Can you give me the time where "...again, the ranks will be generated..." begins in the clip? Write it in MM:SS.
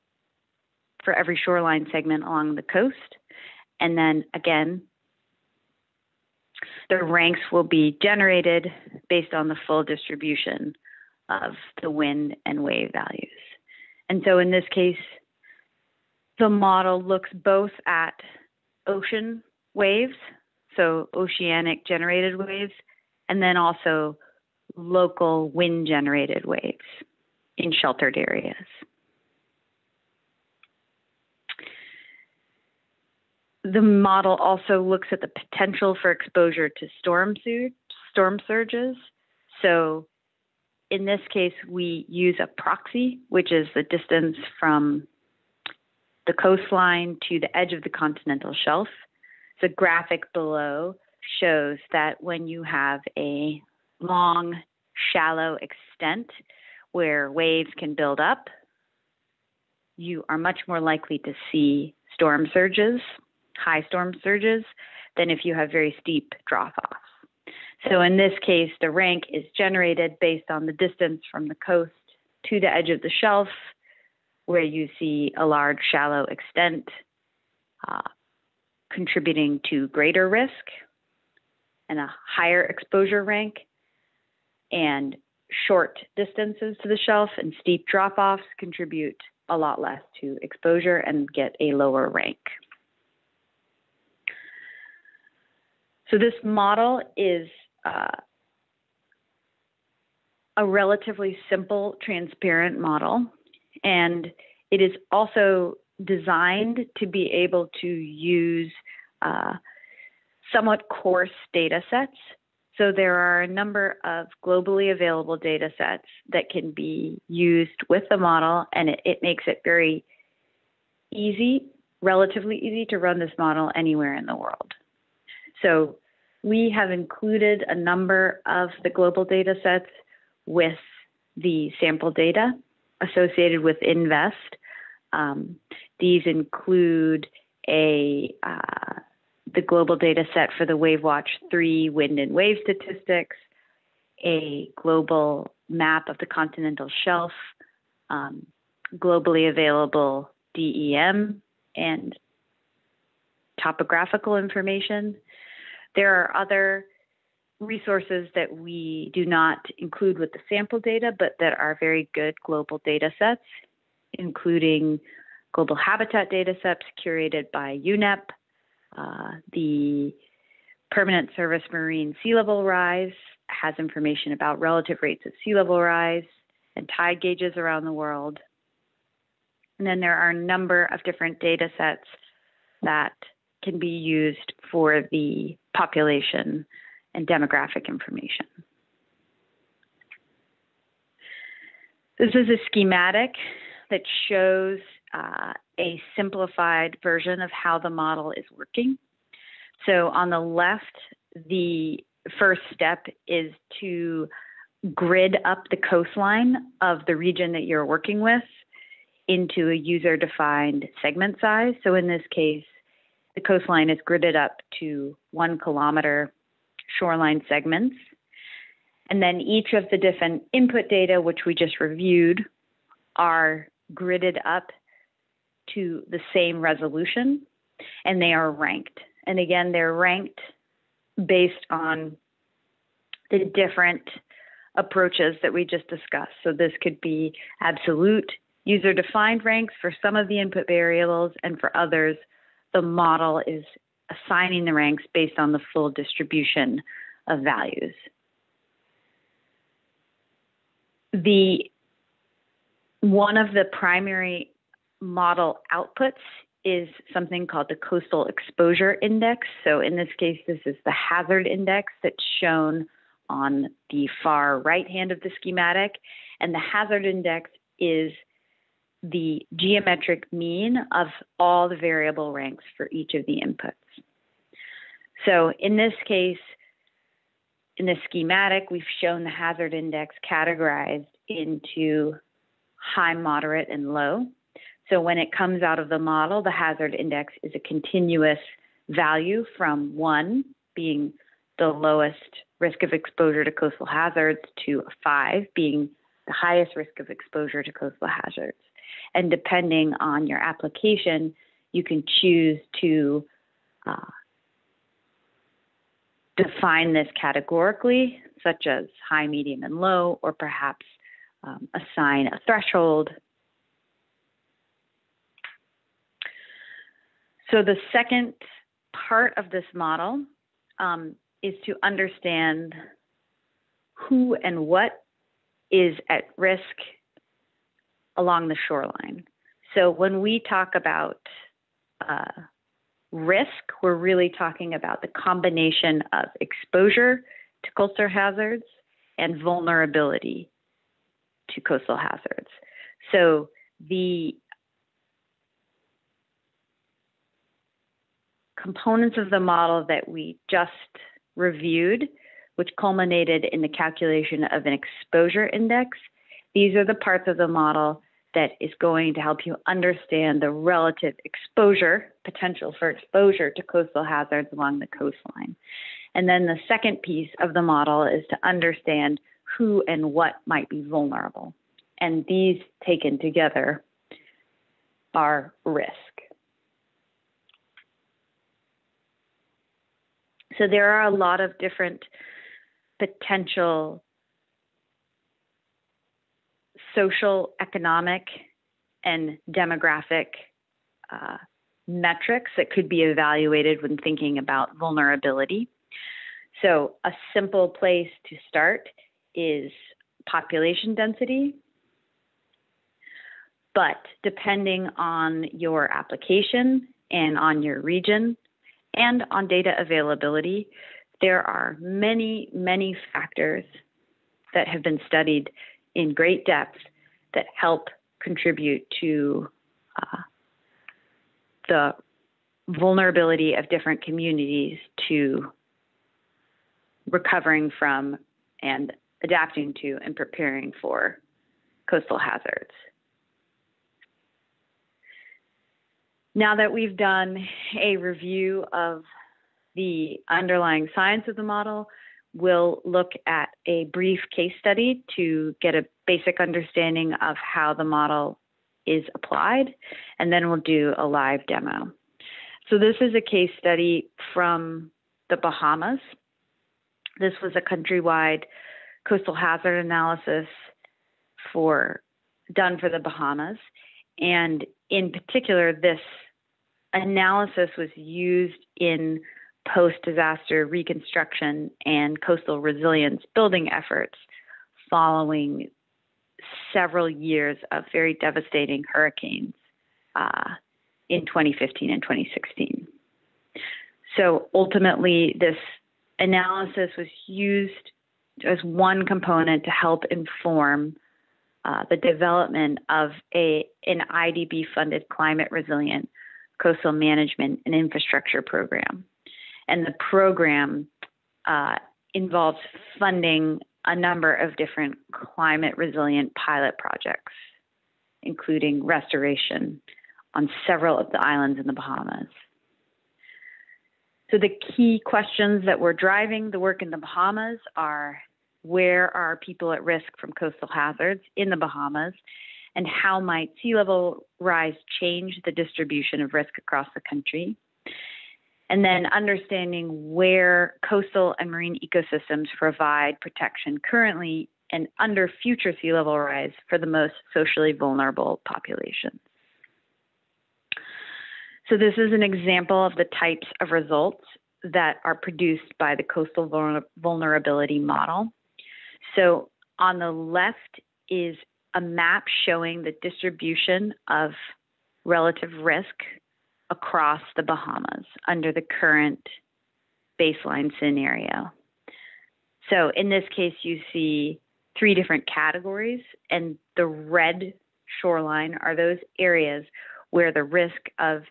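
00:04.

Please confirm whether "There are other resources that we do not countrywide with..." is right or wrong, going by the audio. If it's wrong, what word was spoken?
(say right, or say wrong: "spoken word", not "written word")
wrong: "include", not "countrywide".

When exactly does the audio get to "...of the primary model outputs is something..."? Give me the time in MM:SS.
04:13.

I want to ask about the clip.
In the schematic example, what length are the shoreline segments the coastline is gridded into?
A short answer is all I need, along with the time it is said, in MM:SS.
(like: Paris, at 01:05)
1 kilometer, at 03:35.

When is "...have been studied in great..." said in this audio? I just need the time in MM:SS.
06:54.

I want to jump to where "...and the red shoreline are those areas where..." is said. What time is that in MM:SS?
09:26.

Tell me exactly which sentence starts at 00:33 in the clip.
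The model also looks at the potential for exposure to storm, sur- storm surges.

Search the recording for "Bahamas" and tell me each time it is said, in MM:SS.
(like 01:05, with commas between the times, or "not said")
07:35, 07:42, 08:31, 08:36, 08:41, 09:17.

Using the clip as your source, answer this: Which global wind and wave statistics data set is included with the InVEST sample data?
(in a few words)
WaveWatch 3.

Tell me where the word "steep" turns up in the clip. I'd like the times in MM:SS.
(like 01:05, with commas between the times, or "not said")
01:06, 01:27.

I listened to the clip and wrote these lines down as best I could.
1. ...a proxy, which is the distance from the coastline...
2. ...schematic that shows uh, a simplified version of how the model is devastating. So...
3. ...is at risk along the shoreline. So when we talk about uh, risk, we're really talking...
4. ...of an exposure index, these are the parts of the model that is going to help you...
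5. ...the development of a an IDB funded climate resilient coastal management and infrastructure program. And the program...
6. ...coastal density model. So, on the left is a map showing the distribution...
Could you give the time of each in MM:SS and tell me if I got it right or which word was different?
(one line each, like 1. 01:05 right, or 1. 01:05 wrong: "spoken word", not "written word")
1. 00:42 right
2. 03:12 wrong: "working", not "devastating"
3. 05:25 right
4. 05:54 right
5. 08:11 right
6. 09:06 wrong: "vulnerability", not "density".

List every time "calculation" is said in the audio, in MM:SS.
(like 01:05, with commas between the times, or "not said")
05:53.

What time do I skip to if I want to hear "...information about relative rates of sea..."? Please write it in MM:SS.
02:53.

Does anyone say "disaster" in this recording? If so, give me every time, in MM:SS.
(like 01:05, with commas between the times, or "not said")
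07:49.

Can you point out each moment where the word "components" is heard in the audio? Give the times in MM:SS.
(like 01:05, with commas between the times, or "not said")
05:48, 08:09.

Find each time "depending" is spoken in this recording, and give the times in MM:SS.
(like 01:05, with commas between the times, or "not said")
04:59, 06:44.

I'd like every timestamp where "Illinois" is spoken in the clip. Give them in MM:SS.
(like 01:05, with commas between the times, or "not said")
not said.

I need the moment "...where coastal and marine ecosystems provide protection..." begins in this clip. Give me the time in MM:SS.
08:50.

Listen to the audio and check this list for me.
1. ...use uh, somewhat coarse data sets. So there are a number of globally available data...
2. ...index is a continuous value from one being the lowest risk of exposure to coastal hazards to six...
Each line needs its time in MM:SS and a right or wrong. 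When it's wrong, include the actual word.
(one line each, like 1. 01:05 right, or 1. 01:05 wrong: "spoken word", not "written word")
1. 01:47 right
2. 04:46 wrong: "five", not "six".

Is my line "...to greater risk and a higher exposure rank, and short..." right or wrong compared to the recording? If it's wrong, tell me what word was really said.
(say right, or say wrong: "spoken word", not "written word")
right.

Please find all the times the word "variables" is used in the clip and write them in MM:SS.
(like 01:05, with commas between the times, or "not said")
04:00, 04:31.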